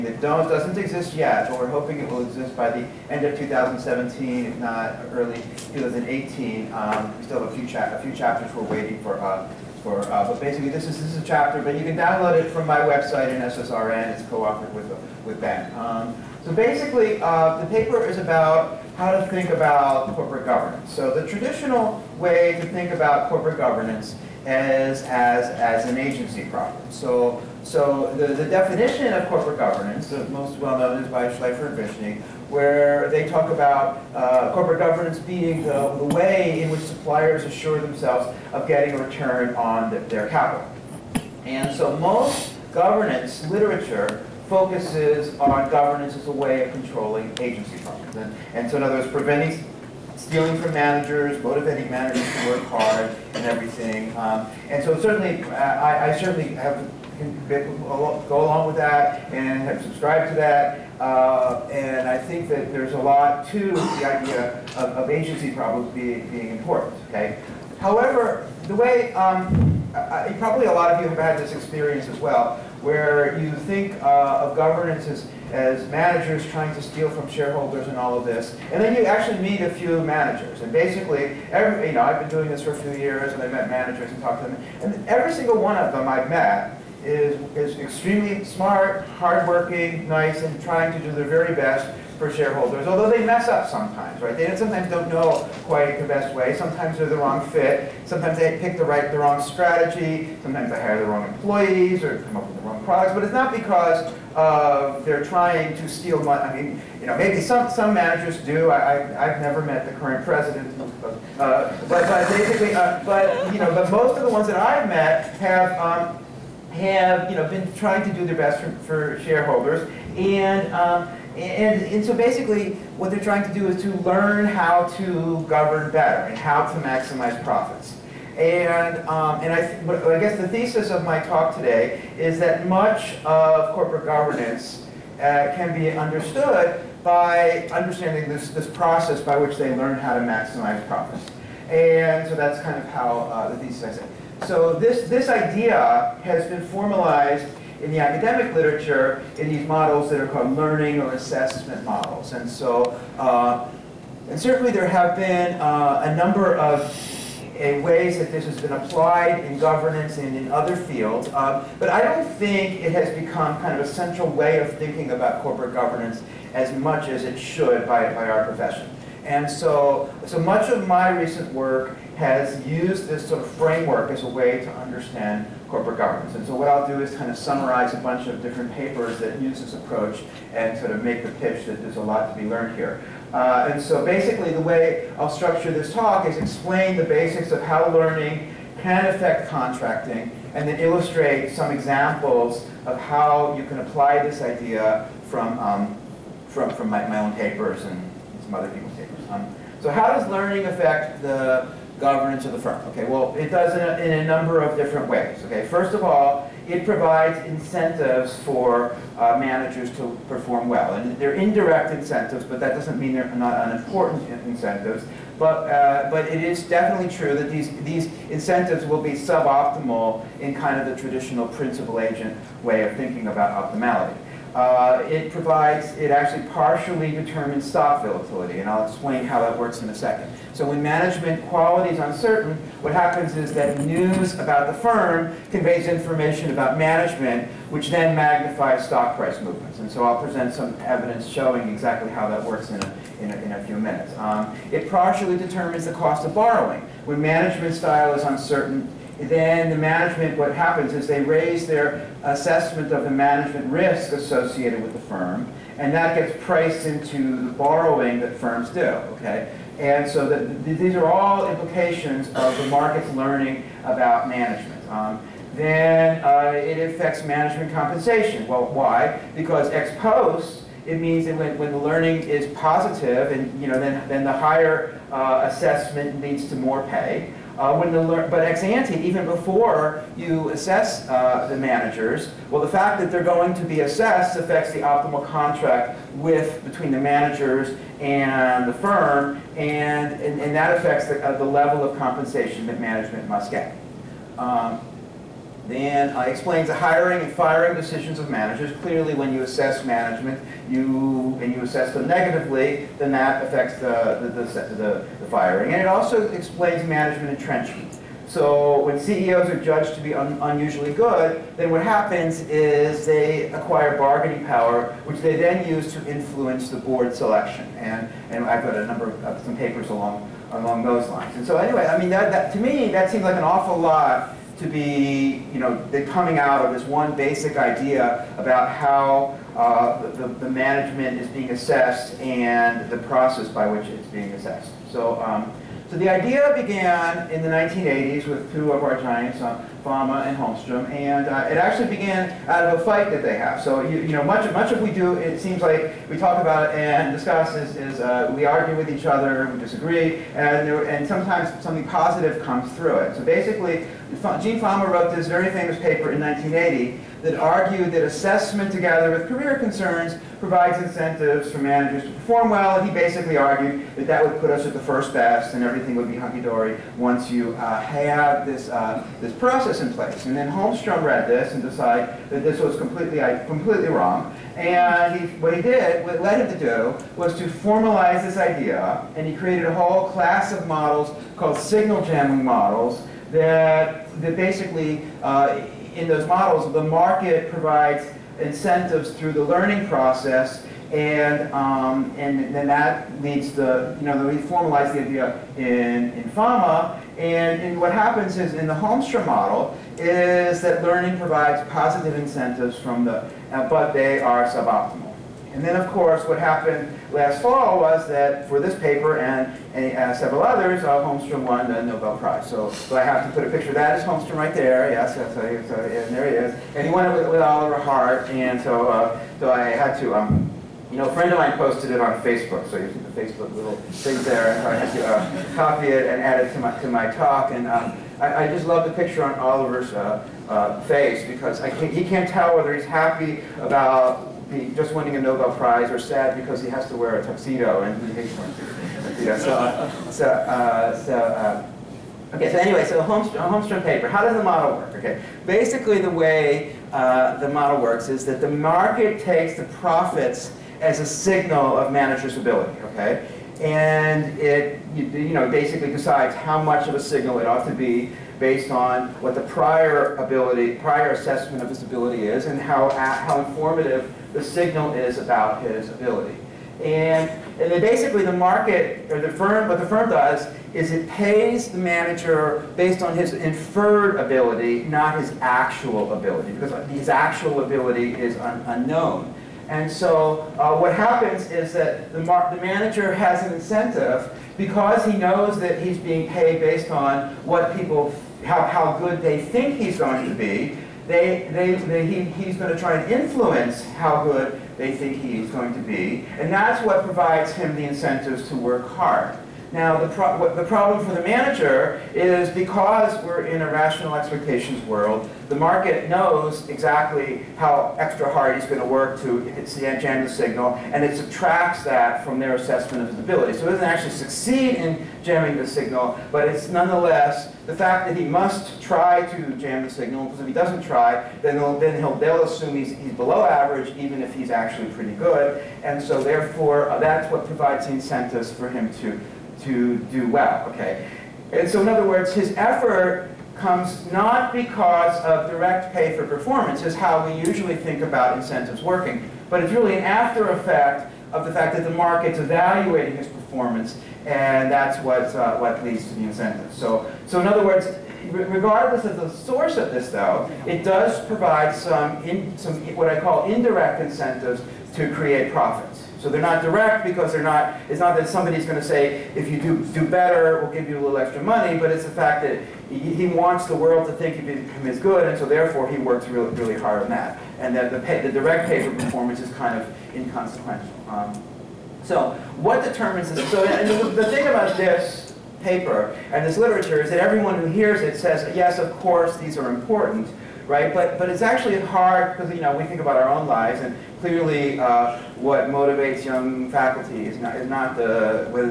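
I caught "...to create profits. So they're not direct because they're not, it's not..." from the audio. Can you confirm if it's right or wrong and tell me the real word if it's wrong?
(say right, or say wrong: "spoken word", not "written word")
right.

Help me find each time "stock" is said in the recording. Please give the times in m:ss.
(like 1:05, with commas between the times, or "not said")
3:47, 3:58.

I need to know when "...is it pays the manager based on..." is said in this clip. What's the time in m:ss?
7:50.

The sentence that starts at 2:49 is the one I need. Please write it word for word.
And so, so much of my recent work has used this sort of framework as a way to understand corporate governance.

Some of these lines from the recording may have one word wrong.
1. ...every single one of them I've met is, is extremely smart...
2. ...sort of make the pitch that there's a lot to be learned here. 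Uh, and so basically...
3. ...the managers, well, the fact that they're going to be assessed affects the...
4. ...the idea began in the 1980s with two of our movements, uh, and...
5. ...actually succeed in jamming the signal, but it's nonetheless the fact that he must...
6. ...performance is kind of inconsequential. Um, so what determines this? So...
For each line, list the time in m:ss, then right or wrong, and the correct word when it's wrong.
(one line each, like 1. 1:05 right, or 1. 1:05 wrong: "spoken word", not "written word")
1. 1:25 right
2. 3:00 right
3. 4:41 right
4. 5:35 wrong: "giants", not "movements"
5. 8:33 right
6. 9:28 right.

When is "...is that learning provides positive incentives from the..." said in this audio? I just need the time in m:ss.
6:39.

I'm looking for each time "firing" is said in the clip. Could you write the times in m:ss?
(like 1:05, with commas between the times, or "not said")
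4:57, 5:05.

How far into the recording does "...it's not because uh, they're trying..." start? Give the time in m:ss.
1:43.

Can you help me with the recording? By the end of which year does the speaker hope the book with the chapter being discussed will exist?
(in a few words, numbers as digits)
2017.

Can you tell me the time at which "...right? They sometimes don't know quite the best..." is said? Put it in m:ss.
1:34.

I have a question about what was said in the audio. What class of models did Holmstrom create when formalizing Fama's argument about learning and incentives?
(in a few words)
signal jamming models.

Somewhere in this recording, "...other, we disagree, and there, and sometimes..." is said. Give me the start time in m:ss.
5:49.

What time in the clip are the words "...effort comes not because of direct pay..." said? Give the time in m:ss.
8:52.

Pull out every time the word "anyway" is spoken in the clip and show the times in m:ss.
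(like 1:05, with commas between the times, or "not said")
5:21, 7:22.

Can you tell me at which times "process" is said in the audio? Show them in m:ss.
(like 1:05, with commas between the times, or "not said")
2:18, 5:32, 6:09, 6:29.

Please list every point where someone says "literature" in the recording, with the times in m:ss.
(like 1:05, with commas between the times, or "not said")
0:43, 2:28, 9:36.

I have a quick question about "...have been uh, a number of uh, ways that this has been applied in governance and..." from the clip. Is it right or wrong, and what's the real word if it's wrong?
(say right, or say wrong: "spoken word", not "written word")
right.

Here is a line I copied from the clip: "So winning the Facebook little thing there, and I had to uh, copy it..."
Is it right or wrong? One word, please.
wrong.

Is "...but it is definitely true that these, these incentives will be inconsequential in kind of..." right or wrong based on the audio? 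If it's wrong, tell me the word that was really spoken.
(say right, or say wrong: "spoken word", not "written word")
wrong: "suboptimal", not "inconsequential".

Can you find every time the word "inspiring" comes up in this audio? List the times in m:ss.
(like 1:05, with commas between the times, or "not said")
not said.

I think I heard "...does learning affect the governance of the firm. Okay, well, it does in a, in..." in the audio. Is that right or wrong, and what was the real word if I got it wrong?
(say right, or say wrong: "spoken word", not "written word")
right.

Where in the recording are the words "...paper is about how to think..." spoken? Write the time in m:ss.
0:17.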